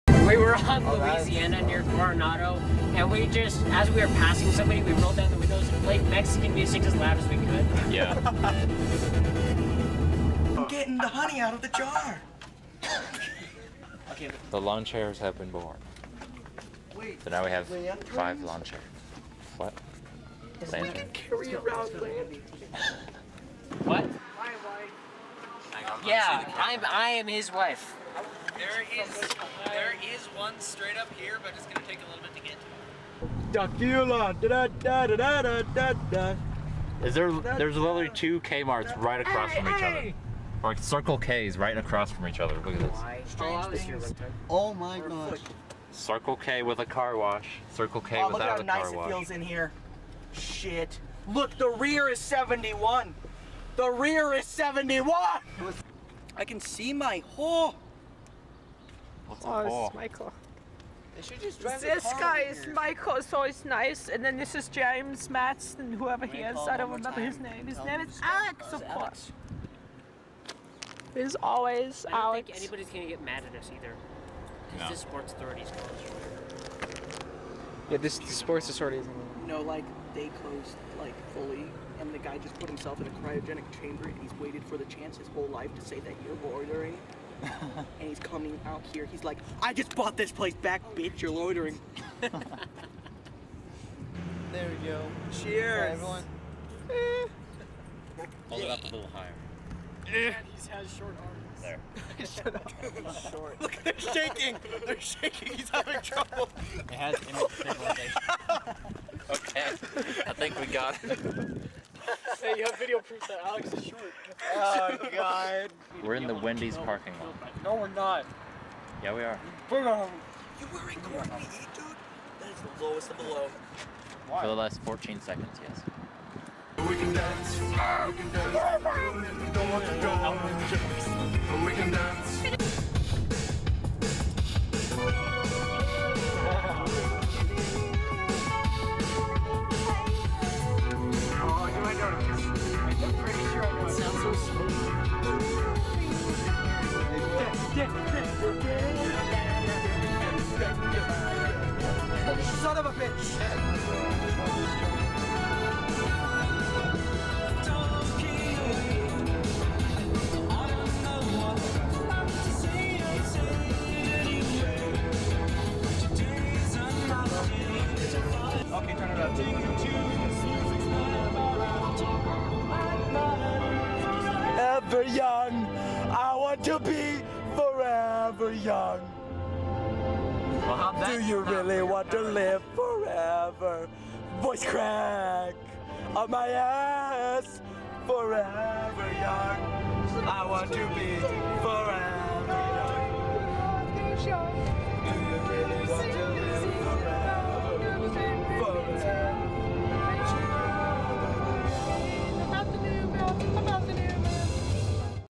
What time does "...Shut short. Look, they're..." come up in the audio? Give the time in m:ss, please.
1:42.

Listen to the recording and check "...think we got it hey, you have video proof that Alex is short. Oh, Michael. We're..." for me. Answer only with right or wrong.
wrong.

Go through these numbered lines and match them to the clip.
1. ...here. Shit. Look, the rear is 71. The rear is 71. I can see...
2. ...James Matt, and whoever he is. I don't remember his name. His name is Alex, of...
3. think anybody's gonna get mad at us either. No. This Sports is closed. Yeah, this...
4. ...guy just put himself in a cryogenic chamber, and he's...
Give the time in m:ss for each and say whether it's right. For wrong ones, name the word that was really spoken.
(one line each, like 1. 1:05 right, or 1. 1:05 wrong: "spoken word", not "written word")
1. 0:49 right
2. 1:04 right
3. 1:12 right
4. 1:22 right.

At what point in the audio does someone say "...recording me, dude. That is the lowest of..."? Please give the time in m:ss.
2:00.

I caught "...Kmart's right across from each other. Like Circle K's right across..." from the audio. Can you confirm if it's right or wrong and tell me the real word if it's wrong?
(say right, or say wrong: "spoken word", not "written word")
right.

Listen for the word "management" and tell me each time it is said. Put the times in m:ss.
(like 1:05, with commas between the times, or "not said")
not said.